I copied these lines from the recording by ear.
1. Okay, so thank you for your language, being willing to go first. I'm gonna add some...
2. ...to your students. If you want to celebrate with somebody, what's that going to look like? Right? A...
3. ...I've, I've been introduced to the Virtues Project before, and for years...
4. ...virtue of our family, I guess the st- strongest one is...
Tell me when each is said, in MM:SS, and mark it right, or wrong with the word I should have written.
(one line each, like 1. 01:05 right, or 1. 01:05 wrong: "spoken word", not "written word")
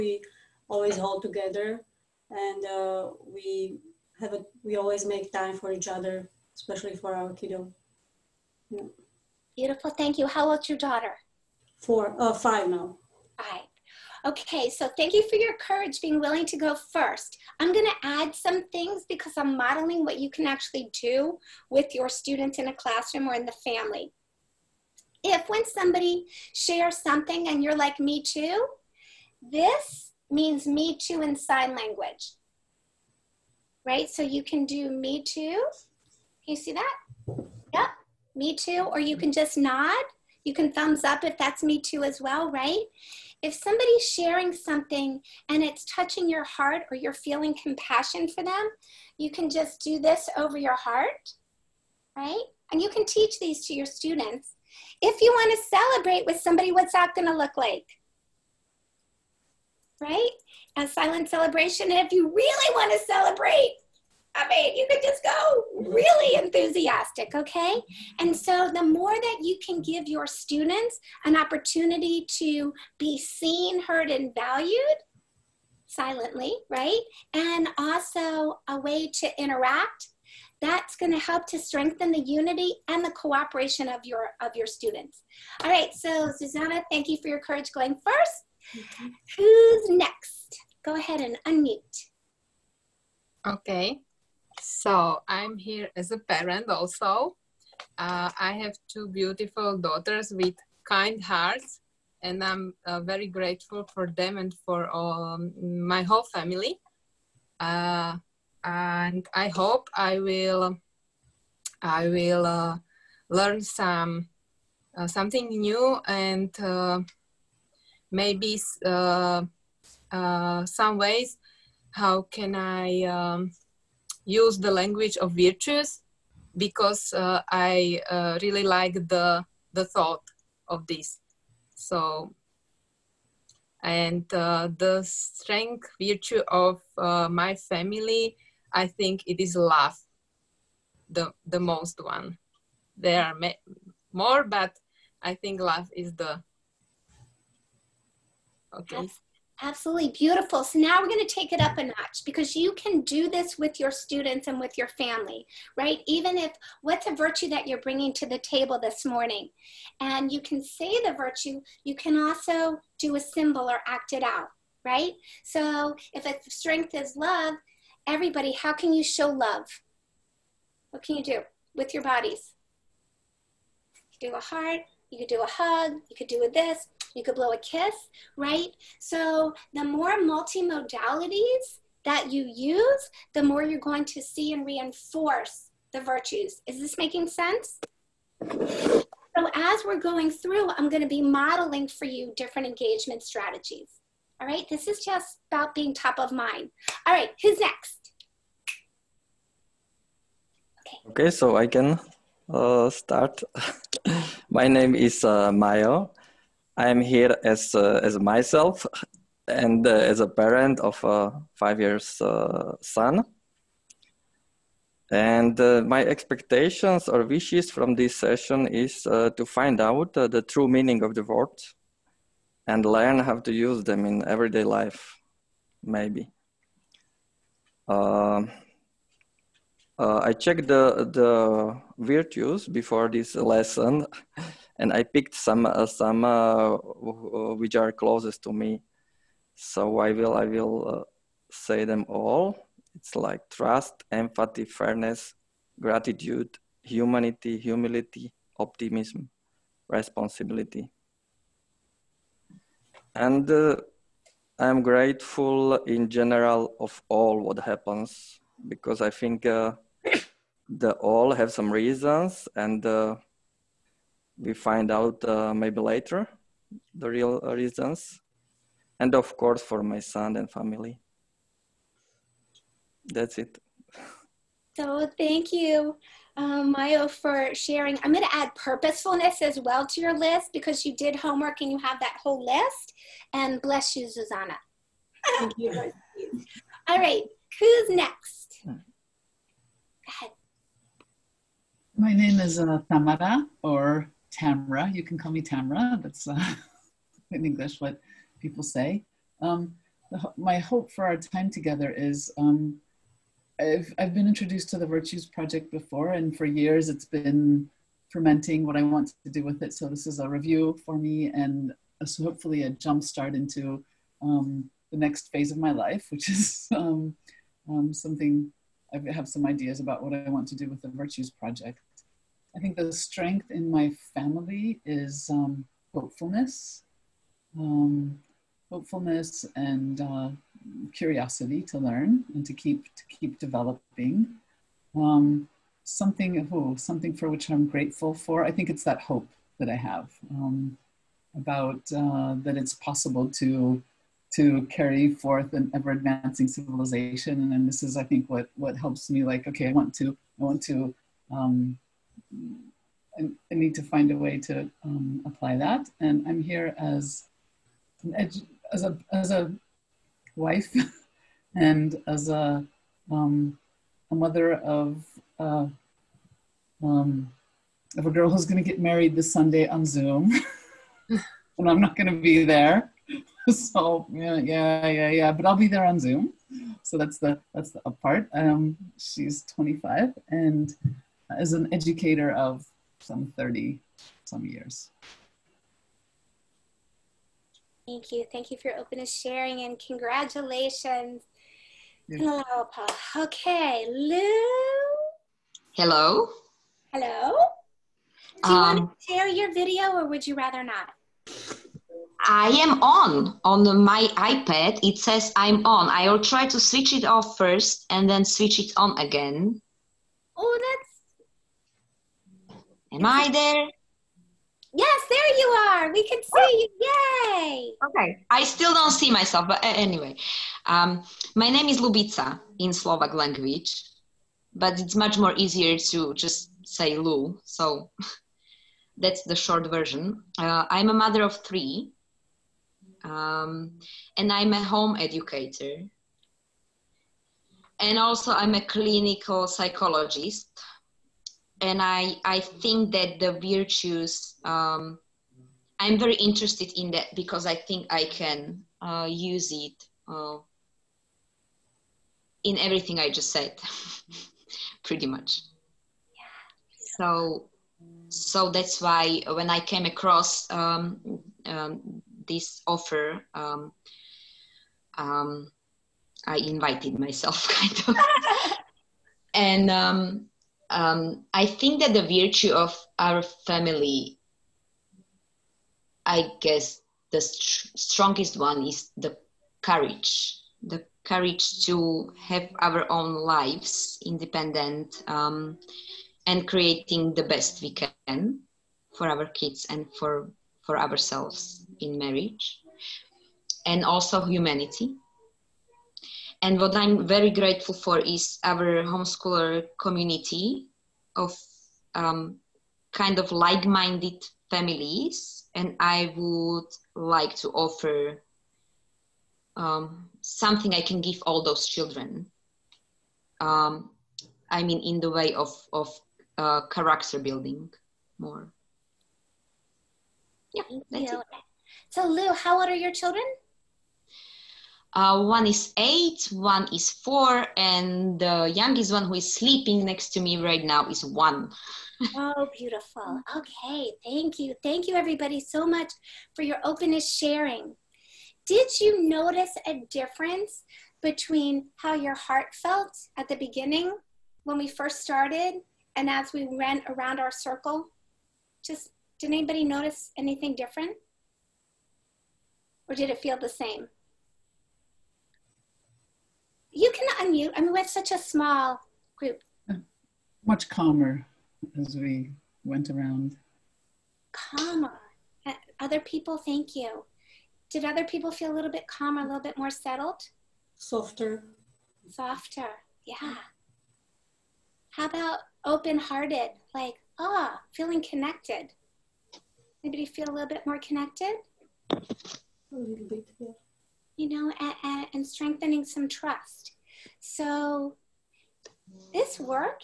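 1. 00:14 wrong: "courage", not "language"
2. 00:53 right
3. 05:03 right
4. 07:52 right.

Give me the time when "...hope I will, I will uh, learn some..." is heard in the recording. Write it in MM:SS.
01:49.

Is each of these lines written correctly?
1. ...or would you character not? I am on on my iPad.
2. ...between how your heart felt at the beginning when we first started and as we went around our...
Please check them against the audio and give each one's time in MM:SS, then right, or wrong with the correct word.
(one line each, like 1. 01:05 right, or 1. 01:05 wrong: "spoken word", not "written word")
1. 06:39 wrong: "rather", not "character"
2. 09:01 right.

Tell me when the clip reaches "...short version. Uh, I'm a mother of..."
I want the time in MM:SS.
07:09.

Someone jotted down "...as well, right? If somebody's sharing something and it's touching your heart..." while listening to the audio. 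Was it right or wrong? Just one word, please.
right.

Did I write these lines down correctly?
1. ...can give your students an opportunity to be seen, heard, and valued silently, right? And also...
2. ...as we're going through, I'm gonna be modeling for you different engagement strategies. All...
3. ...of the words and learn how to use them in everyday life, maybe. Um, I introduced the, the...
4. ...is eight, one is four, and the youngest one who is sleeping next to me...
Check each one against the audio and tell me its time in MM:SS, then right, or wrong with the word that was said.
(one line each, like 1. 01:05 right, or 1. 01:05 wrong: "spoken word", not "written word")
1. 01:09 right
2. 03:09 right
3. 03:41 wrong: "checked", not "introduced"
4. 08:45 right.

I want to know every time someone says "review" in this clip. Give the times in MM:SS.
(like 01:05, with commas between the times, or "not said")
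05:10.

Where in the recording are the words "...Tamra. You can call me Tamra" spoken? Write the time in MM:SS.
04:54.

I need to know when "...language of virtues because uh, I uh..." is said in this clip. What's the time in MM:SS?
02:04.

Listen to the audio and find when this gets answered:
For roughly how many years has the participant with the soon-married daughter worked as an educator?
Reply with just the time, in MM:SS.
06:23.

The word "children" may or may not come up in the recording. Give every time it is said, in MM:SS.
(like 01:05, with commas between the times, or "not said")
08:31, 08:42.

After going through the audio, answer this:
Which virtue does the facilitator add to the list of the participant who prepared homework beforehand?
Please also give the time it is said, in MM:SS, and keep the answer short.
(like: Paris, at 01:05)
Purposefulness, at 04:38.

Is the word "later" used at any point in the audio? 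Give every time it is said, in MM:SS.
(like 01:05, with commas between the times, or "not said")
04:25.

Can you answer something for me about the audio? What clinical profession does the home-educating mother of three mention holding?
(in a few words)
Clinical psychologist.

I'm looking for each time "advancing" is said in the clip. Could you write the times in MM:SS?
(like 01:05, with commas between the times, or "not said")
05:45.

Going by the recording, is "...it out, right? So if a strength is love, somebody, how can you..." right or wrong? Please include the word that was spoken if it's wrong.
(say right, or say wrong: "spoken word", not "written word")
wrong: "everybody", not "somebody".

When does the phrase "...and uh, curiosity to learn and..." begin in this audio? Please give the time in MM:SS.
05:29.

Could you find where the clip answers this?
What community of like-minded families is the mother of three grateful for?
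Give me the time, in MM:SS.
08:18.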